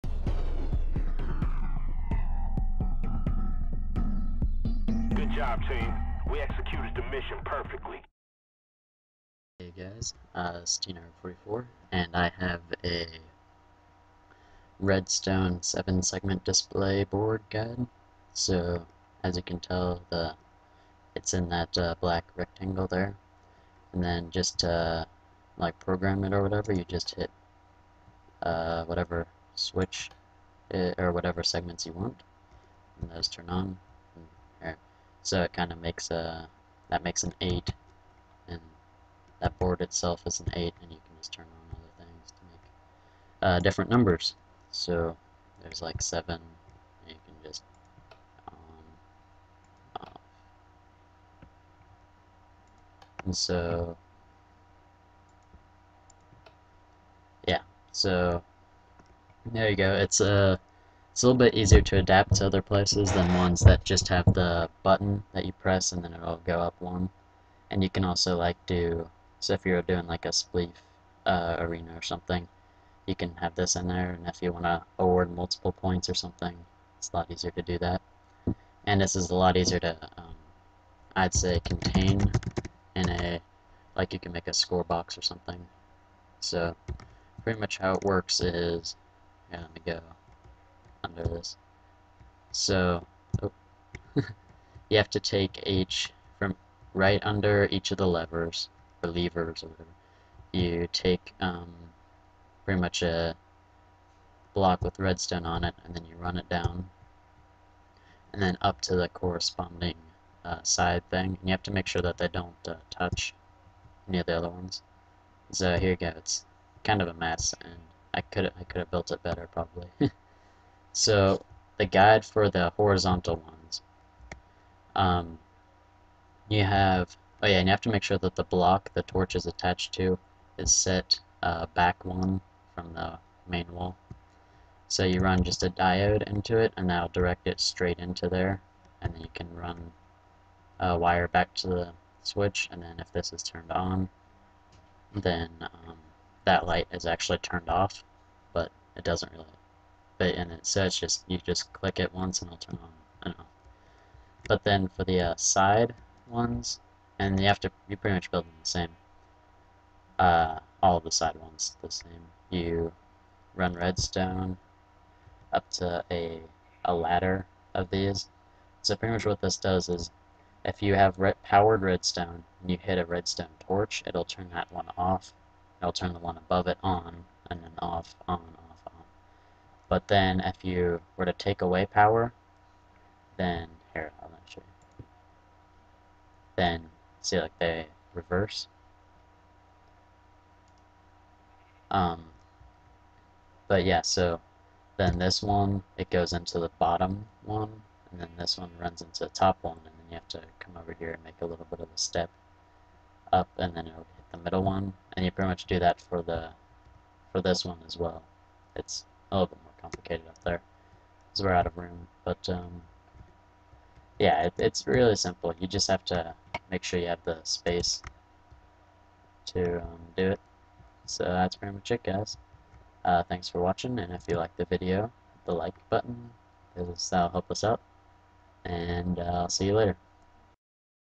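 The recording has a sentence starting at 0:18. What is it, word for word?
So, as you can tell, the it's in that uh, black rectangle there.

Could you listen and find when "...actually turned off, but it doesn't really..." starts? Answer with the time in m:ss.
2:27.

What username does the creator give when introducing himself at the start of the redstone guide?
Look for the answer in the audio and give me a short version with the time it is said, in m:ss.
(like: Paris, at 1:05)
TNARG44, at 0:10.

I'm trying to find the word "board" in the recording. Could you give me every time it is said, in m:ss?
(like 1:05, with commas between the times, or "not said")
0:17, 0:39.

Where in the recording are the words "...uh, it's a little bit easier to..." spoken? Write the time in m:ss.
1:00.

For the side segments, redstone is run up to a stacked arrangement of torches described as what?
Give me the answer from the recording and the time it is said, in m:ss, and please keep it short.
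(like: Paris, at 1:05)
A ladder, at 2:46.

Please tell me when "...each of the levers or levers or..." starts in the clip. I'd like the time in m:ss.
1:37.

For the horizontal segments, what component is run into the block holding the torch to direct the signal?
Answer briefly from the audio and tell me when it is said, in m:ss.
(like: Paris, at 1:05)
A diode, at 2:15.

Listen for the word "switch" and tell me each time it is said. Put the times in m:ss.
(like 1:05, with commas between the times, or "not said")
0:29, 2:22.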